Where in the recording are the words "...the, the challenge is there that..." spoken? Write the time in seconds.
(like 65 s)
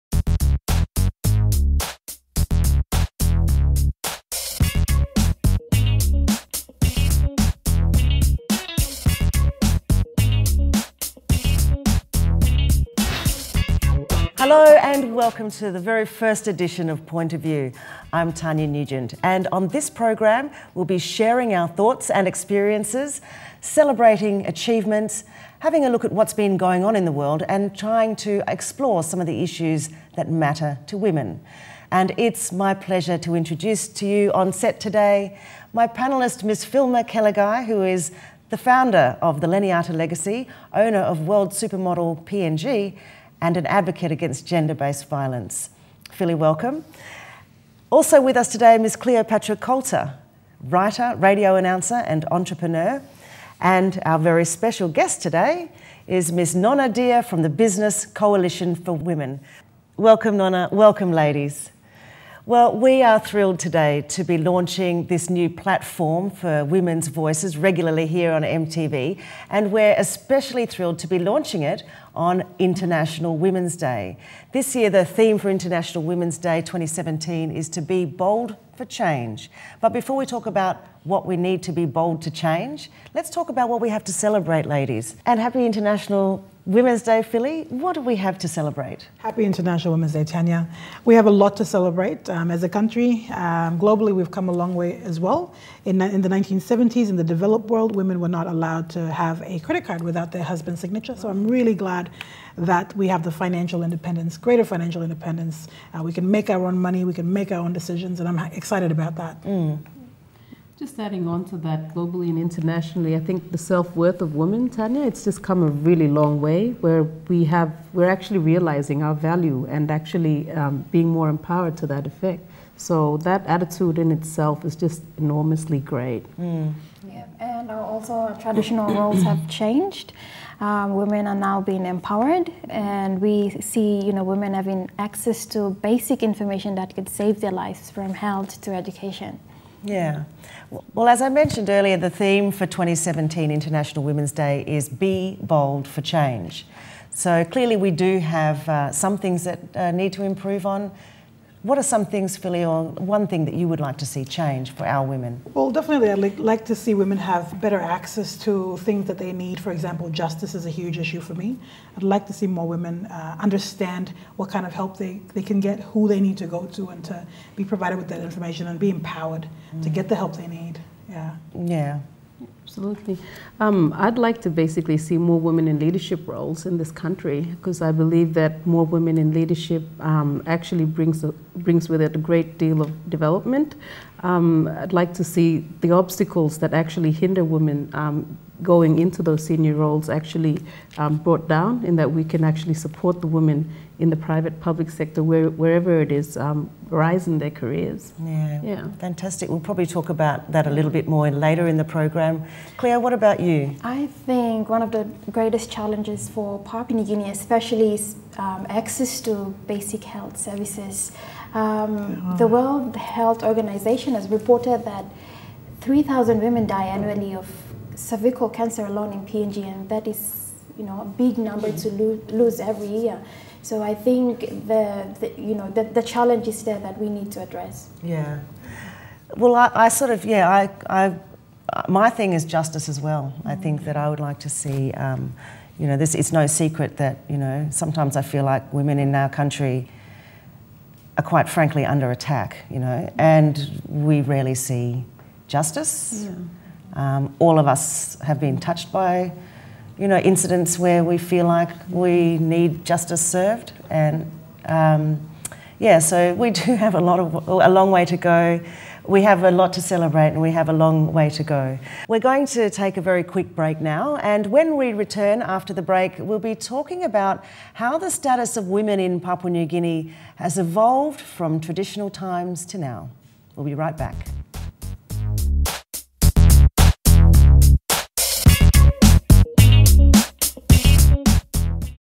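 225 s.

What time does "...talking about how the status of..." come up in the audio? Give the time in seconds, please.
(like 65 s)
266 s.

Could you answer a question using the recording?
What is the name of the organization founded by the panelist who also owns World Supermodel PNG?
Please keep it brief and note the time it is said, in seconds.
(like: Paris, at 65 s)
Leniata Legacy, at 39 s.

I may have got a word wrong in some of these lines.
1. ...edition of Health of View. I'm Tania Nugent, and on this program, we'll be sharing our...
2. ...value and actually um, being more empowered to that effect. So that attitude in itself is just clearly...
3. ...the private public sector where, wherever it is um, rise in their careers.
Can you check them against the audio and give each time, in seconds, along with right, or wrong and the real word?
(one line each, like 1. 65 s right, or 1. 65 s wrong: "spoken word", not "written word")
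1. 16 s wrong: "Point", not "Health"
2. 119 s wrong: "enormously", not "clearly"
3. 194 s right.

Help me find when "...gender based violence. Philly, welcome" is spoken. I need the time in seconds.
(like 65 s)
44 s.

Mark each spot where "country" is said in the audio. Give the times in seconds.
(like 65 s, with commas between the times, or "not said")
92 s, 176 s, 239 s.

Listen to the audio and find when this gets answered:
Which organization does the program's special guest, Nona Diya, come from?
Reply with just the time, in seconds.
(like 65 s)
57 s.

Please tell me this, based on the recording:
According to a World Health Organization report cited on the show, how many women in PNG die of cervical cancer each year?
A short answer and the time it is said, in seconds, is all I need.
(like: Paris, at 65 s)
3,000, at 215 s.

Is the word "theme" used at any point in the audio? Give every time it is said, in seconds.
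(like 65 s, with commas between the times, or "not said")
75 s, 142 s.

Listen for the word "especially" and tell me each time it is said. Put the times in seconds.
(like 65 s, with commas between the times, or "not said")
69 s, 207 s.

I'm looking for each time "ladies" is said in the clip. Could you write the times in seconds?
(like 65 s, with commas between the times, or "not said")
61 s, 84 s.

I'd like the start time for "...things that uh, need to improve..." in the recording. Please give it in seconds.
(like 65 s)
149 s.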